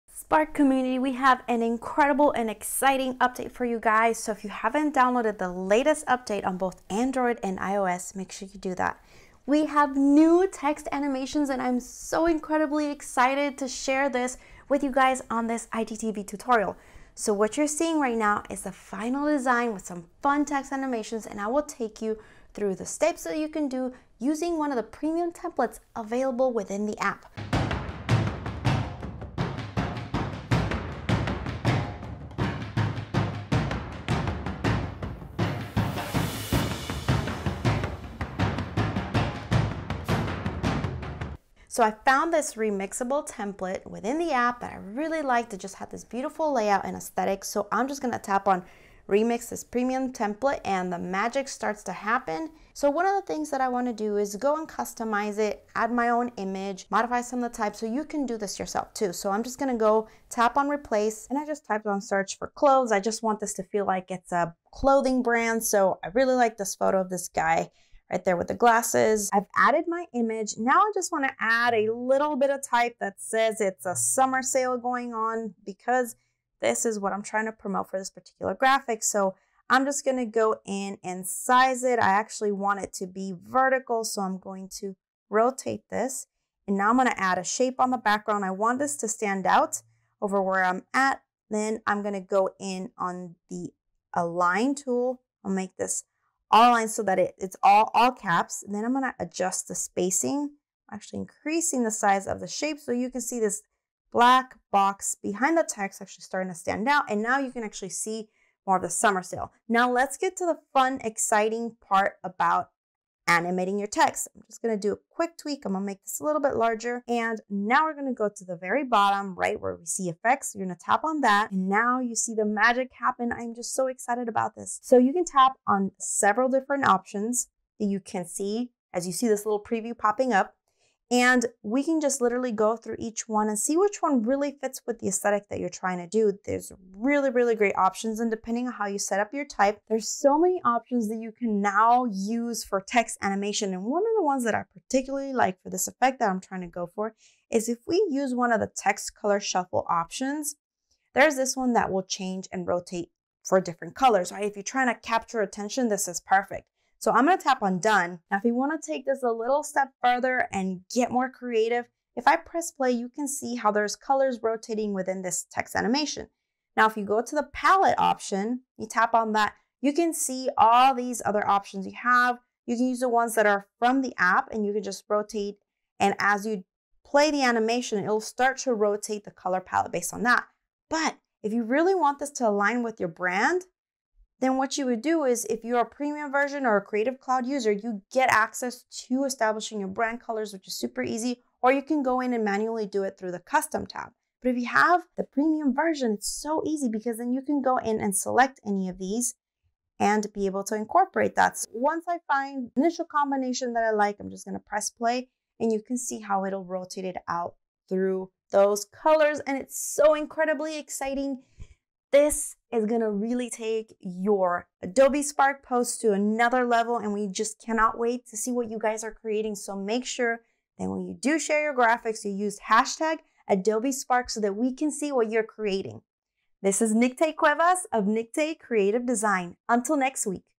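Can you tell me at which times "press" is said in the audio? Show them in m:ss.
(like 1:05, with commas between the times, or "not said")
2:42, 3:24.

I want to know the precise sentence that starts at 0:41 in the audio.
So I found this remixable template within the app that I really liked.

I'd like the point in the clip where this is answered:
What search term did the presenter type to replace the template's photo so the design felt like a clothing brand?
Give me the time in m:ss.
1:02.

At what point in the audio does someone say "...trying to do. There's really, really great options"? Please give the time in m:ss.
2:15.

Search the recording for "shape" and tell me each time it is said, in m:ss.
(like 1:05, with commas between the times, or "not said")
1:27, 1:42.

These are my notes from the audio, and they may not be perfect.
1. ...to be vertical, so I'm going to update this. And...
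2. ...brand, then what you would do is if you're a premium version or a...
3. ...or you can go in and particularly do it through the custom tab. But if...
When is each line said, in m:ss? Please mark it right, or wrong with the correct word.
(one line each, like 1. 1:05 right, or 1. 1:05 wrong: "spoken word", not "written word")
1. 1:22 wrong: "rotate", not "update"
2. 3:03 right
3. 3:11 wrong: "manually", not "particularly".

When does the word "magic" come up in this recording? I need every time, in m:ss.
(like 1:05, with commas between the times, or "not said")
0:50, 2:02.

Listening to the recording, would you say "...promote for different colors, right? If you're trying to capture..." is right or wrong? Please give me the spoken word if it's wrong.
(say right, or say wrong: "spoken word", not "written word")
wrong: "rotate", not "promote".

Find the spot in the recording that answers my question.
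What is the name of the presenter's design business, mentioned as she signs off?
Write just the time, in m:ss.
3:48.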